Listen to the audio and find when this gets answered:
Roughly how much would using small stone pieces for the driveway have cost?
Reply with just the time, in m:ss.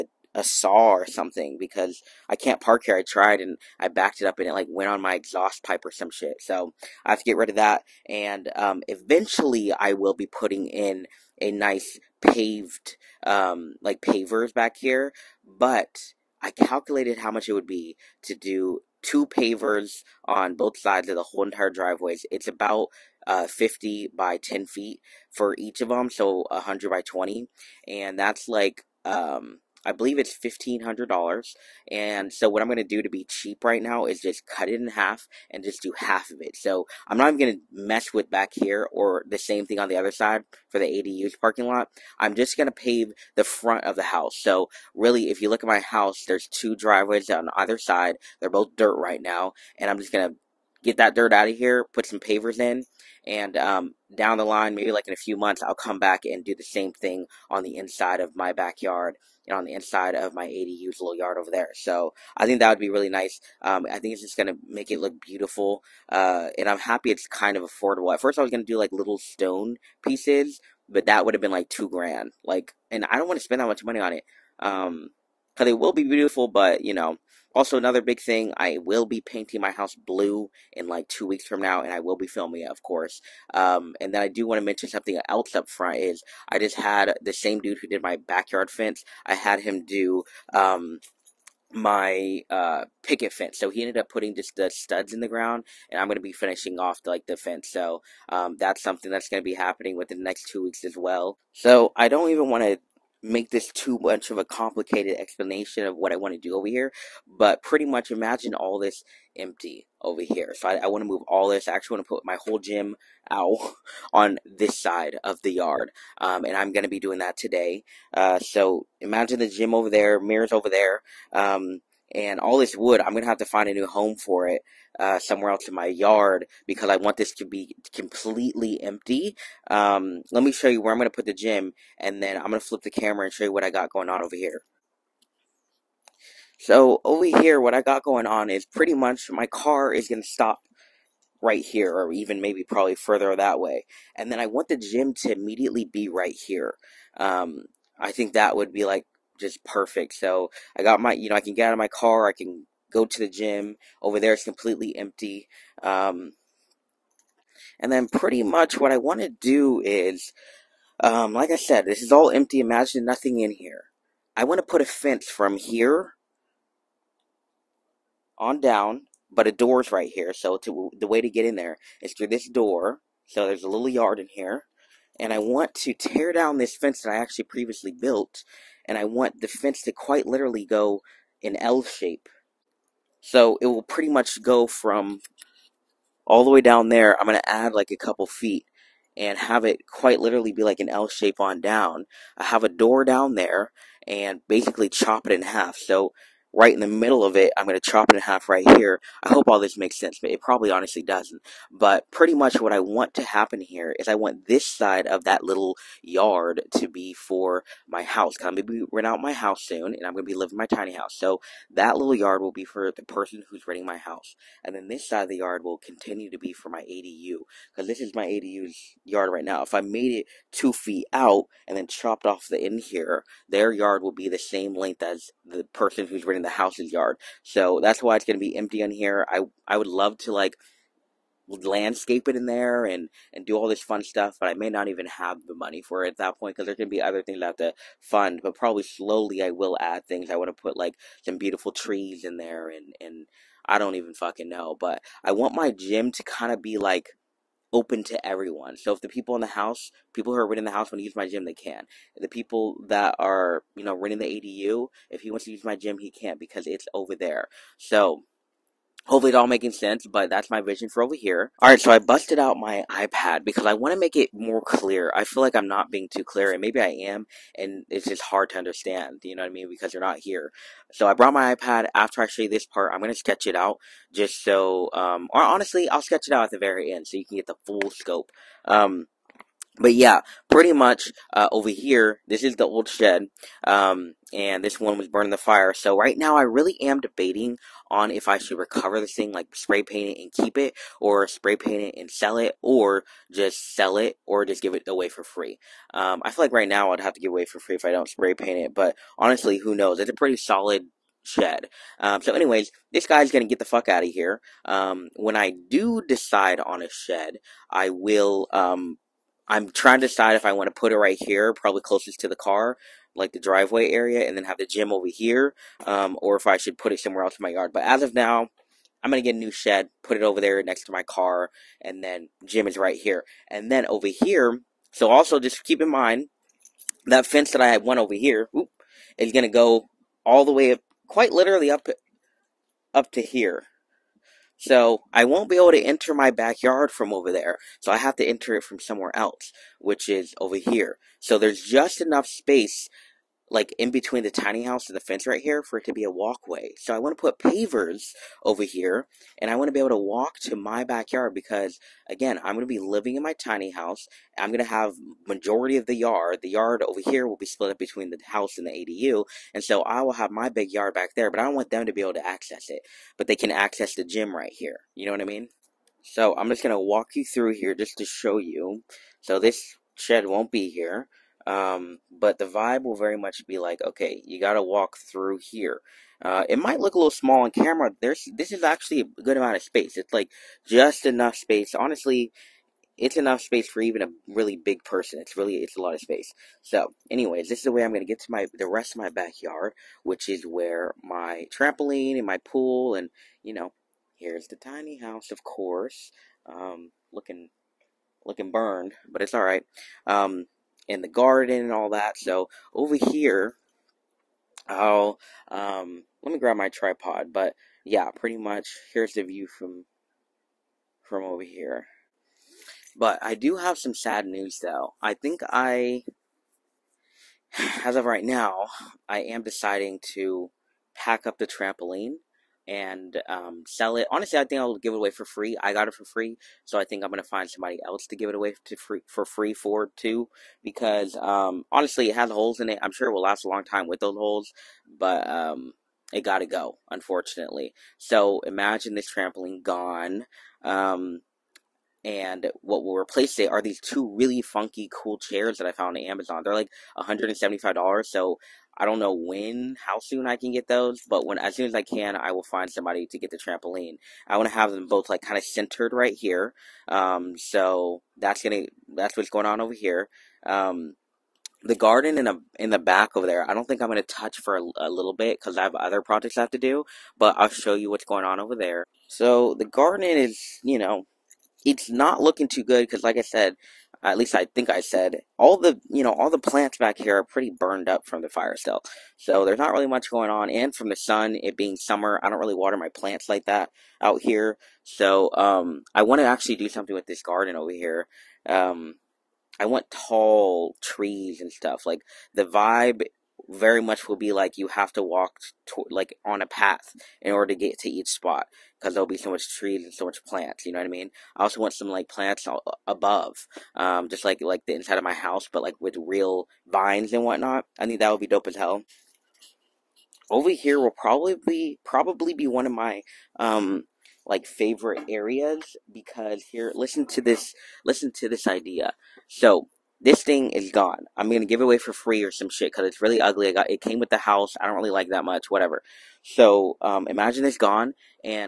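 1:11.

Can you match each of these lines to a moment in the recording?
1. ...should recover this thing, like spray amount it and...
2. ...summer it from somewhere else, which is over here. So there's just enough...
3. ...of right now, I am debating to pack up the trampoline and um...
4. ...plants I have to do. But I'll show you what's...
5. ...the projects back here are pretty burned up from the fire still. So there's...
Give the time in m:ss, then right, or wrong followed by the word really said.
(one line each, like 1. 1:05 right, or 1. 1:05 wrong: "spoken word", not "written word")
1. 4:48 wrong: "paint", not "amount"
2. 5:38 wrong: "enter", not "summer"
3. 6:57 wrong: "deciding", not "debating"
4. 7:45 wrong: "projects", not "plants"
5. 7:56 wrong: "plants", not "projects".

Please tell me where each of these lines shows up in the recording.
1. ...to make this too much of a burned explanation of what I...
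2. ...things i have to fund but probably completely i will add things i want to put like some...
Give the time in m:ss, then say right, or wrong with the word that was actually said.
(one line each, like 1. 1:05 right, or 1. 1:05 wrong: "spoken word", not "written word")
1. 1:42 wrong: "complicated", not "burned"
2. 3:57 wrong: "slowly", not "completely".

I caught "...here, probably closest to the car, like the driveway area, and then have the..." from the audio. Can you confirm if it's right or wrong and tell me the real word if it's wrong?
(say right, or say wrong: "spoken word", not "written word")
right.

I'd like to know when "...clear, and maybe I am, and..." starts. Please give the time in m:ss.
4:26.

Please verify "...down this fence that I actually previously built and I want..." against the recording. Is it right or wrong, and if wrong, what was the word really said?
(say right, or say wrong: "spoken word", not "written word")
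right.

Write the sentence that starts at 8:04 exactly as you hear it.
So um, I want to actually do something with this garden over here.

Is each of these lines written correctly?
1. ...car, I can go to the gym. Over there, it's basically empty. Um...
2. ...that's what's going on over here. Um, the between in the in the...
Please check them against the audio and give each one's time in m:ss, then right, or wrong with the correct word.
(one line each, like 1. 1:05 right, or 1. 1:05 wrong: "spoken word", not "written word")
1. 2:31 wrong: "completely", not "basically"
2. 7:38 wrong: "garden", not "between".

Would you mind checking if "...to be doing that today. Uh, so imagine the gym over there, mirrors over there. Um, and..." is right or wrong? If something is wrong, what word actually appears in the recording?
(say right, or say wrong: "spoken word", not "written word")
right.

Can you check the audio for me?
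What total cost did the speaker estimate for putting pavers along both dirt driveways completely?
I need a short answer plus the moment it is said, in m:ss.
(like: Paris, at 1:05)
$1,500, at 0:30.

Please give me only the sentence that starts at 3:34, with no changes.
And then this side of the yard will continue to be for my ADU, because this is my ADU's yard right now.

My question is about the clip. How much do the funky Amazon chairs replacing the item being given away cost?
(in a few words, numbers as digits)
$175.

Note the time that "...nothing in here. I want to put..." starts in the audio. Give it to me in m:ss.
2:43.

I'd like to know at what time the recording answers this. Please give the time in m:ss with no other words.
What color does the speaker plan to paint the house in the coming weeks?
1:19.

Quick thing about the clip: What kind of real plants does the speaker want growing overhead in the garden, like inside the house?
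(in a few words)
Vines.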